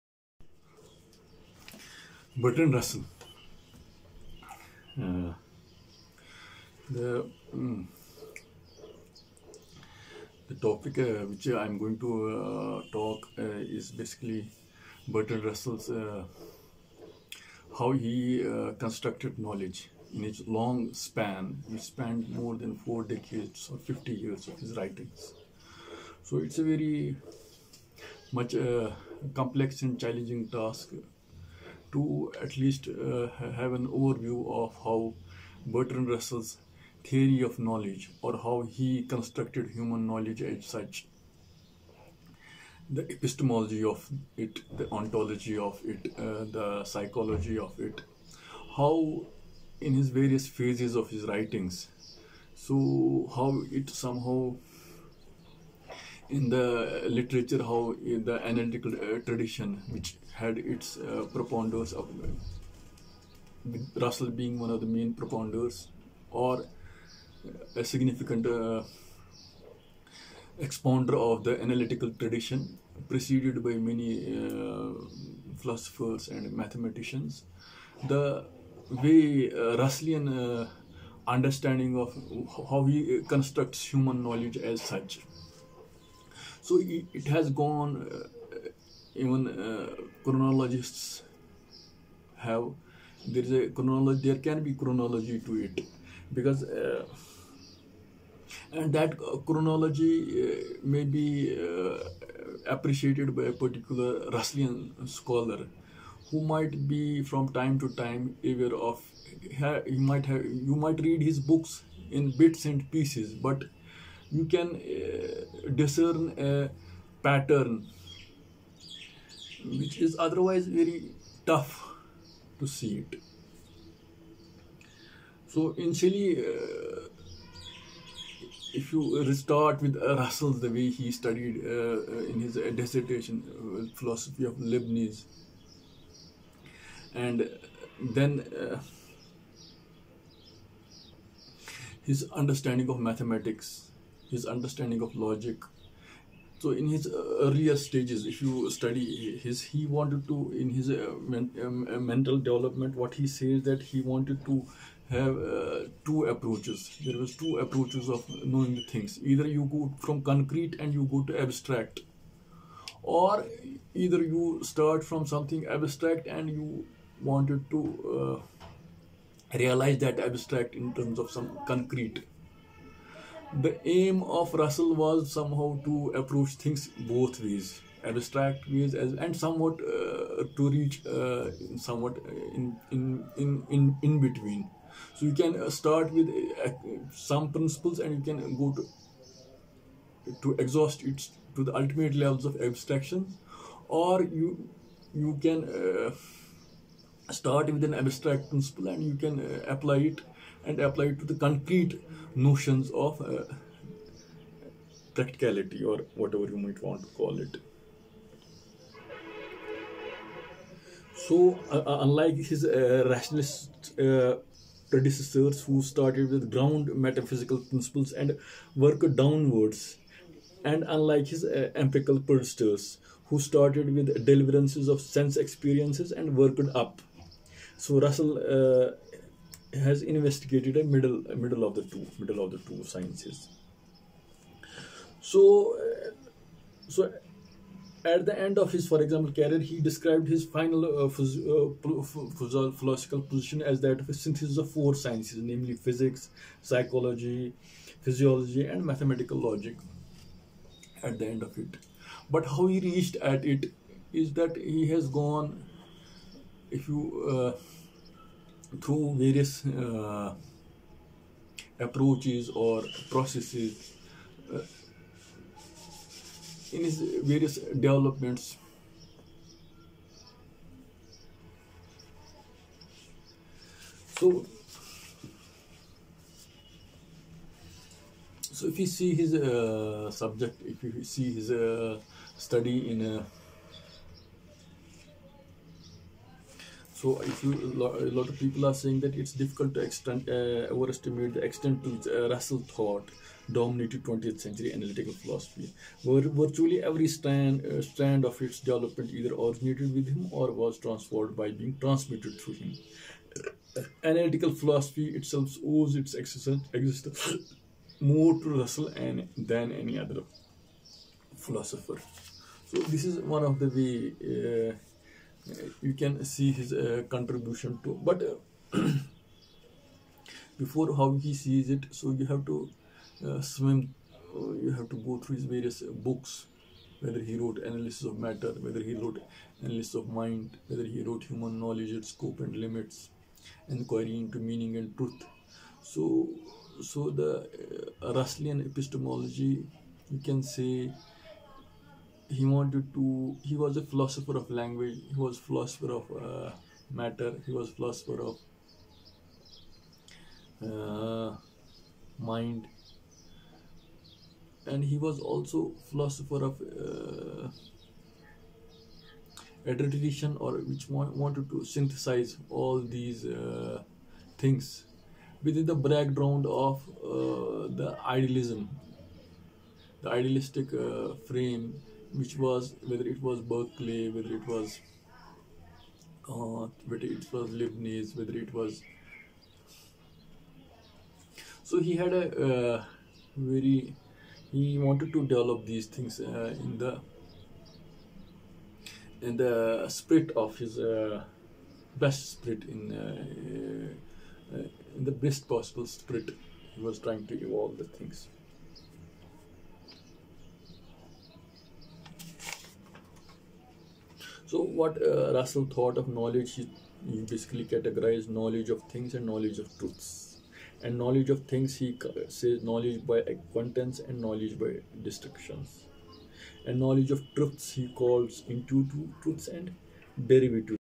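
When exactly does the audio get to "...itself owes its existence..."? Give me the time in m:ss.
5:05.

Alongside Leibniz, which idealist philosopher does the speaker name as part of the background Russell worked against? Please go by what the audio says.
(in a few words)
Berkeley.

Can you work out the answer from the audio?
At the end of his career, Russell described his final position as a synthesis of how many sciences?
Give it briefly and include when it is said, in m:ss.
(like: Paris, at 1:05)
4, at 4:04.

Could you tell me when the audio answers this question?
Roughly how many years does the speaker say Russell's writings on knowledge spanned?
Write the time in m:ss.
0:23.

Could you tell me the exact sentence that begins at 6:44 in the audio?
So, what uh, Russell thought of knowledge, he, he basically categorized knowledge of things and knowledge of truths.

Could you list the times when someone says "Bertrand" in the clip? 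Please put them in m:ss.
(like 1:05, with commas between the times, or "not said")
0:02, 0:15, 0:35.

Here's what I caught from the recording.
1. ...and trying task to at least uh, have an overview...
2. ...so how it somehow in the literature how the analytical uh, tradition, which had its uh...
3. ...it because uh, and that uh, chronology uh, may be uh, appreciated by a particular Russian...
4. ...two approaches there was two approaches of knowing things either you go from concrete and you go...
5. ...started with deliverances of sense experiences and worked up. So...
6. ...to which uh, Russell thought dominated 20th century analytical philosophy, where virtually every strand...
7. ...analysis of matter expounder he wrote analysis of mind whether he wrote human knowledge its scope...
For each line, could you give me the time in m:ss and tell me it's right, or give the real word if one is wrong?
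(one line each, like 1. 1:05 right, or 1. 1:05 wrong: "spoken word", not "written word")
1. 0:29 wrong: "challenging", not "trying"
2. 0:52 right
3. 1:35 right
4. 2:36 right
5. 3:43 right
6. 4:51 right
7. 5:27 wrong: "whether", not "expounder".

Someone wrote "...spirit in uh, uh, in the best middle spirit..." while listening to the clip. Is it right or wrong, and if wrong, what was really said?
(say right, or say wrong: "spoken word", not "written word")
wrong: "possible", not "middle".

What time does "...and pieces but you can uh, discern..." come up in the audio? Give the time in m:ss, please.
1:52.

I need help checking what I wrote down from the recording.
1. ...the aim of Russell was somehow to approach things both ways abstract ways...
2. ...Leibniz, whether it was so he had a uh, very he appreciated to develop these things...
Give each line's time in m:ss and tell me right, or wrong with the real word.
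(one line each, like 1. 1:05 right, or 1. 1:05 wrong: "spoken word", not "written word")
1. 2:53 right
2. 6:17 wrong: "wanted", not "appreciated".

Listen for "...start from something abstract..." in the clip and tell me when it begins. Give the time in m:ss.
2:44.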